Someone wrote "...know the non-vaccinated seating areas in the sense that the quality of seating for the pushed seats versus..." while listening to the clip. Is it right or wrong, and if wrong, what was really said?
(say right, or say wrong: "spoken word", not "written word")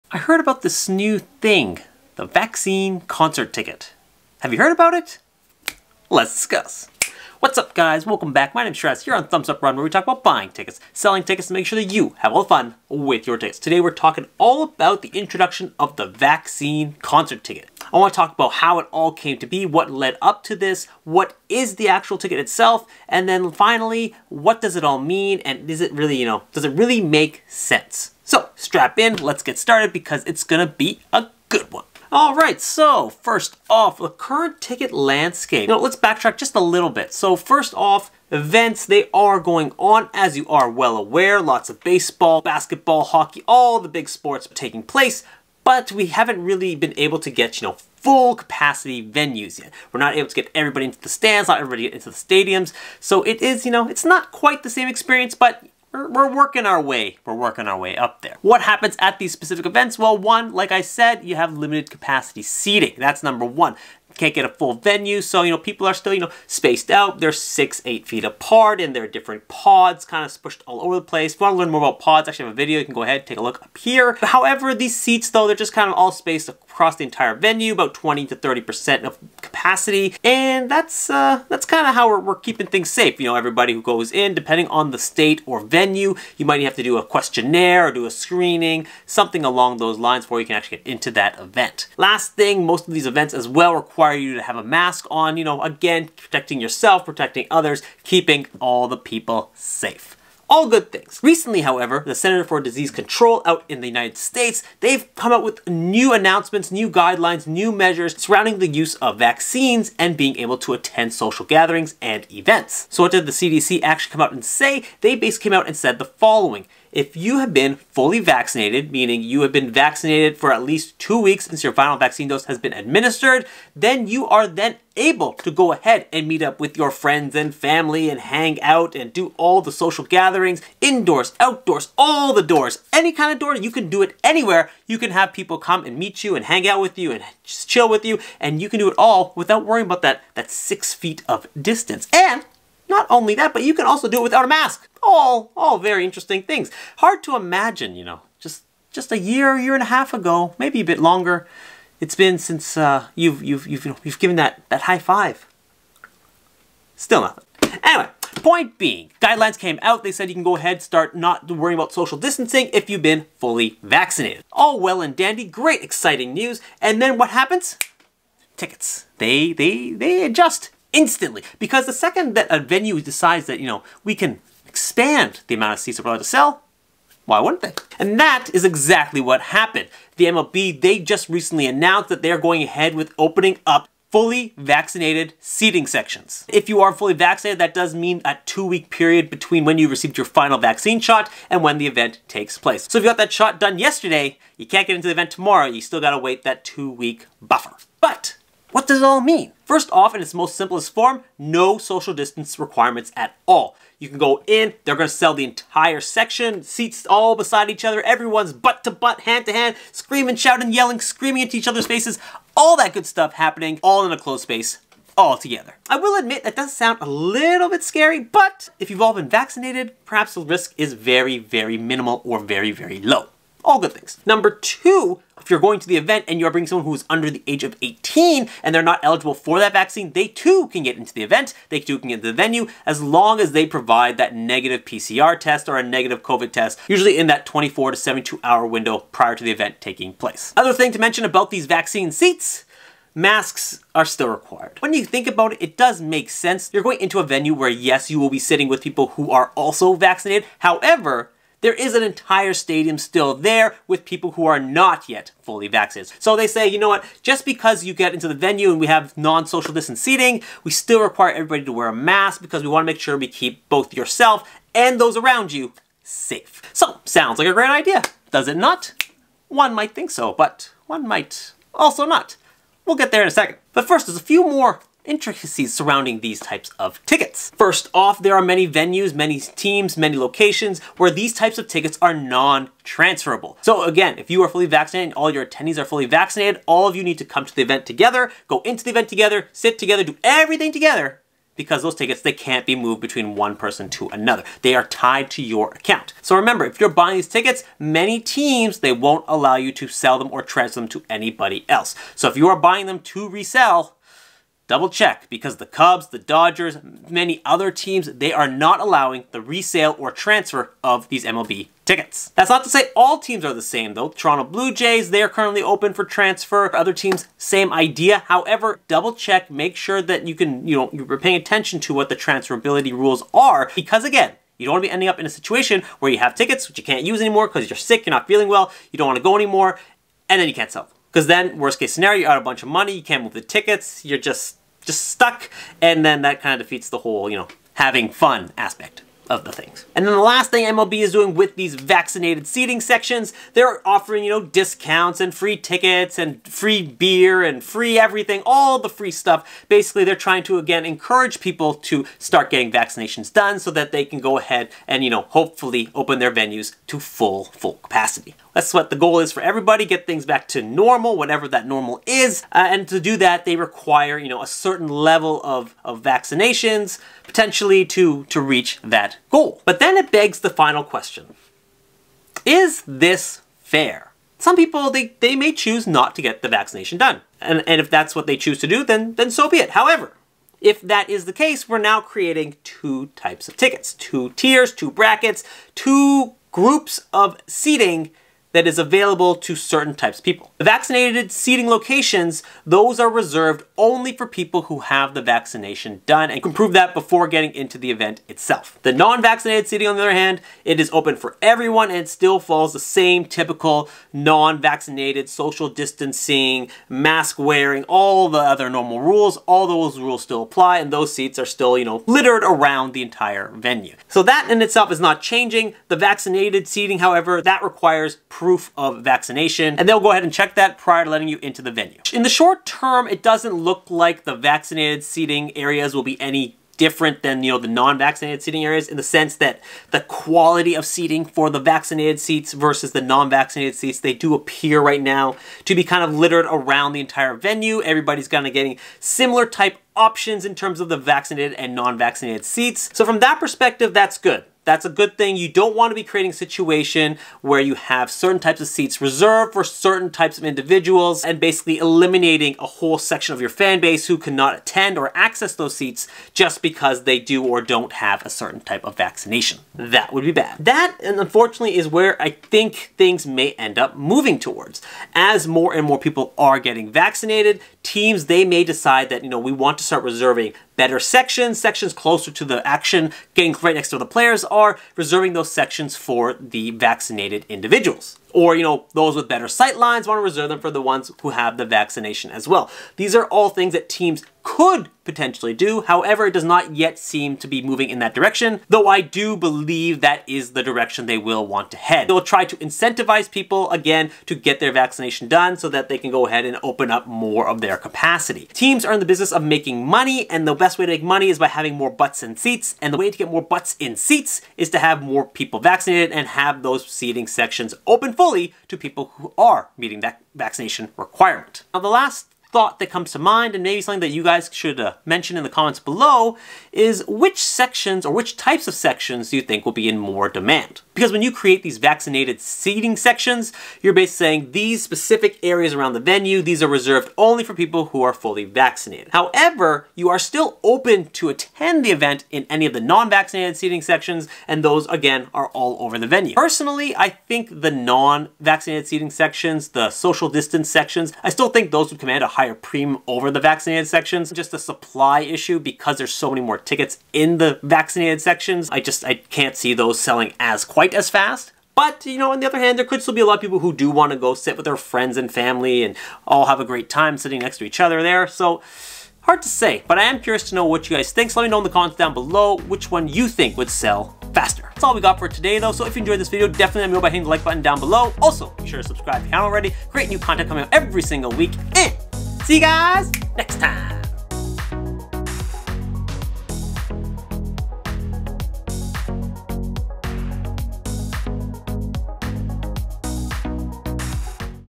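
wrong: "vaccinated", not "pushed".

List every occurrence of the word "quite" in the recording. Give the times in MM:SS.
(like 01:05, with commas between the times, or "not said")
00:54, 09:10.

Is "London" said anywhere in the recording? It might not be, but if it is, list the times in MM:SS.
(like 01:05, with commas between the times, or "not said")
not said.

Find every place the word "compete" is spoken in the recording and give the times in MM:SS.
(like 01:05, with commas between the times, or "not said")
not said.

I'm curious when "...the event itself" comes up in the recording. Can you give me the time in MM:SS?
06:37.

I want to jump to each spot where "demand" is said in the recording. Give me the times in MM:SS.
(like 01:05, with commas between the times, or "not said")
08:40.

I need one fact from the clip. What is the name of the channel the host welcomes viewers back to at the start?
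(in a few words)
Thumbs Up Run.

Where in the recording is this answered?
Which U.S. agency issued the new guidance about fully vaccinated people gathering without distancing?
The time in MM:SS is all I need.
01:42.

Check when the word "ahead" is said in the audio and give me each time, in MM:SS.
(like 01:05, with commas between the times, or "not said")
01:13, 02:05, 02:40, 03:02, 05:54, 07:00, 08:16.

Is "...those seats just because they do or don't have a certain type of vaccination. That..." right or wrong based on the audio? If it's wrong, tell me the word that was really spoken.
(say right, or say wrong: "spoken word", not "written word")
right.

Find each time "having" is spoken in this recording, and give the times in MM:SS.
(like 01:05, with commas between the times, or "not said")
05:37, 08:21.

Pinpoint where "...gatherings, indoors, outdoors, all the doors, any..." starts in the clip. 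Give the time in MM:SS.
02:10.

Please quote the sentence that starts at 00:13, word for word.
Today we're talking all about the introduction of the vaccine concert ticket.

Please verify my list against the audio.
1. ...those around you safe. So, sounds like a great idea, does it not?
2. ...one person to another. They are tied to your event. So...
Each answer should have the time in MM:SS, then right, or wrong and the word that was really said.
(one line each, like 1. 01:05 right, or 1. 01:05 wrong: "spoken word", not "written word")
1. 04:24 right
2. 04:53 wrong: "account", not "event".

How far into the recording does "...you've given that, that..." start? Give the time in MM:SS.
02:34.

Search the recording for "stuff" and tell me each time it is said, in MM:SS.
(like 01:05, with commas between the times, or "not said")
03:33, 05:49.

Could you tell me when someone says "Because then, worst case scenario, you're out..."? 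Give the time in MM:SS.
05:31.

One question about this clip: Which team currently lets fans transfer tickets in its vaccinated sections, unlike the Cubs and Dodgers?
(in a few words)
Toronto Blue Jays.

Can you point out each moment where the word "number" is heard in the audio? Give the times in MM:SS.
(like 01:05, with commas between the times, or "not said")
01:03, 03:44.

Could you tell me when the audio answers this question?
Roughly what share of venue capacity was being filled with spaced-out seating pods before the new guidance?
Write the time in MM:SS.
01:17.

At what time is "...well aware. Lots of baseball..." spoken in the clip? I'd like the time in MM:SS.
00:40.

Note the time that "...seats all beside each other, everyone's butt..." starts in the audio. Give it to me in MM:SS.
03:26.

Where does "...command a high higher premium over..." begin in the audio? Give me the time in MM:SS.
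09:01.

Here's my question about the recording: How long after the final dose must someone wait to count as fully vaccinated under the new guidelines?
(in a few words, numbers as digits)
2 weeks.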